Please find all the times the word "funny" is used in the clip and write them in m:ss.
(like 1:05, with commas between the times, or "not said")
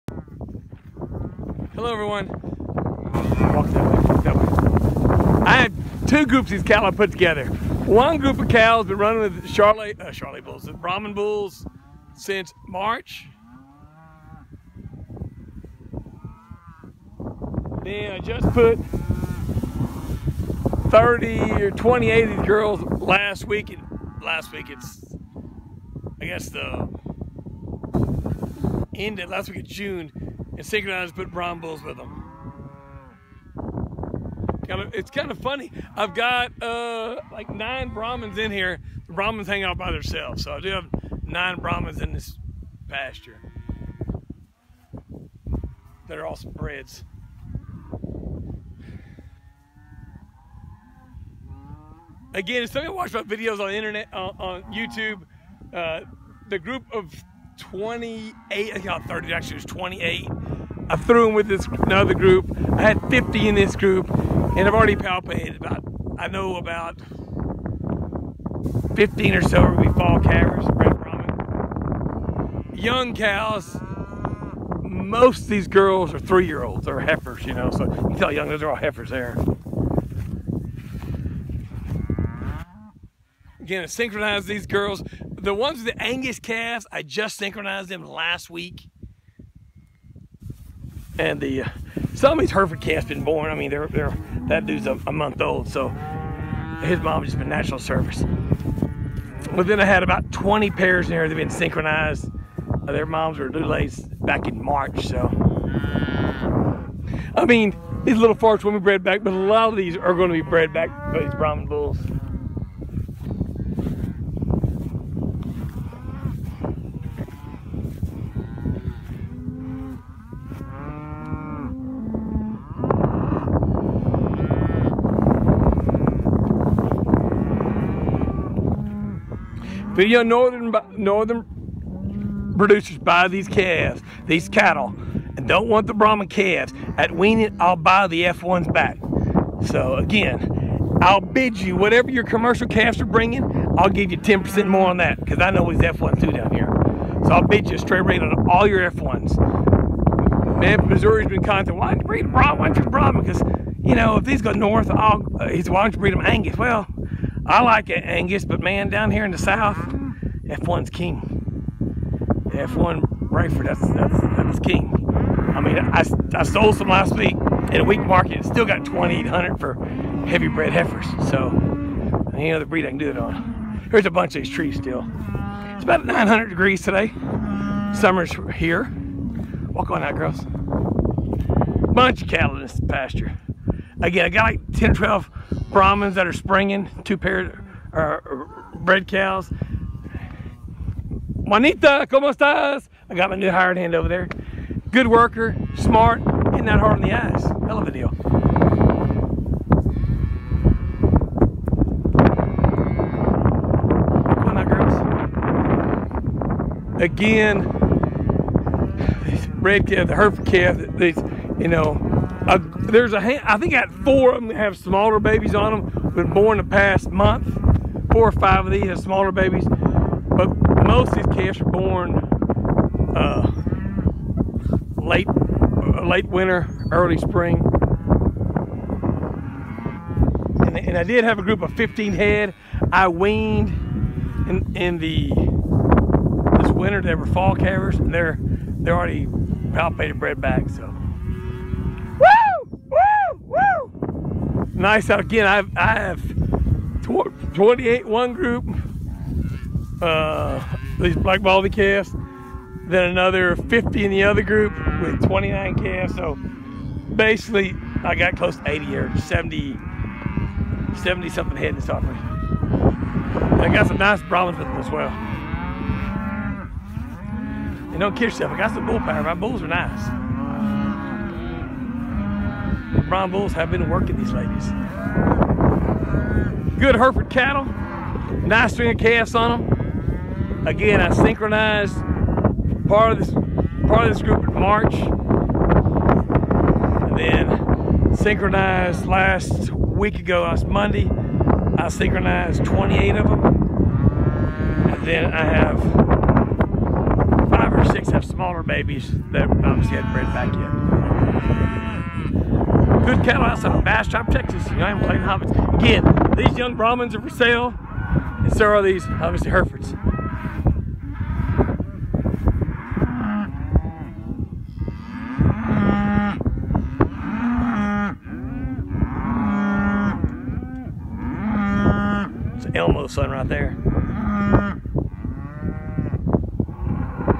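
0:35.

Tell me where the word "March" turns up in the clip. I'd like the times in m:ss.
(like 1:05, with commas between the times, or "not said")
0:12, 1:44, 4:44.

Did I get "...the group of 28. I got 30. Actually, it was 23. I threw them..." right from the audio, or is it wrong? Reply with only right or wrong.
wrong.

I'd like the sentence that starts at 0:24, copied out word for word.
Last week it's, I guess the end of last week of June and synchronized put Brahman bulls with them.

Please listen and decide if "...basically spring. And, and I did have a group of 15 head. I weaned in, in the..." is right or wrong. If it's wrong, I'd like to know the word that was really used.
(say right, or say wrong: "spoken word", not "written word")
wrong: "early", not "basically".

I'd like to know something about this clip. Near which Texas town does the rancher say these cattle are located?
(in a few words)
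Bastrop.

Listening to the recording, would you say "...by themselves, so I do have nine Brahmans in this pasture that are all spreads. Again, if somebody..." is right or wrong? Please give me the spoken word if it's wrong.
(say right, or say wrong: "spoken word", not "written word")
right.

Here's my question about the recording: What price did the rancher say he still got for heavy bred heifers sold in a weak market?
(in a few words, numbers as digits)
2,800.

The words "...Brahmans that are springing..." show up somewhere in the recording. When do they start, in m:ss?
3:05.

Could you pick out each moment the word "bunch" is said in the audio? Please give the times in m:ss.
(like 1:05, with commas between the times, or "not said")
2:54, 3:01.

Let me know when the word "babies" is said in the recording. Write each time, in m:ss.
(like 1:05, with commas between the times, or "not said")
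3:35, 3:39, 4:58.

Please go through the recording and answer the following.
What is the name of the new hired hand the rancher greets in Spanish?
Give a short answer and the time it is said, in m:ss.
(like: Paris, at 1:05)
Juanita, at 3:11.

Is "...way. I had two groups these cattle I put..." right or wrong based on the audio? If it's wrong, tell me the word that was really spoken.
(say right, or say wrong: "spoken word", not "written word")
right.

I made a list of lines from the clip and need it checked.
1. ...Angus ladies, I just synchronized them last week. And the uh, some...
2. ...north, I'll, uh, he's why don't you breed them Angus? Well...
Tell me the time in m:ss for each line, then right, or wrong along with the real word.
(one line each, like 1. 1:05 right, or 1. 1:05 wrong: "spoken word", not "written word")
1. 1:26 wrong: "calves", not "ladies"
2. 2:34 right.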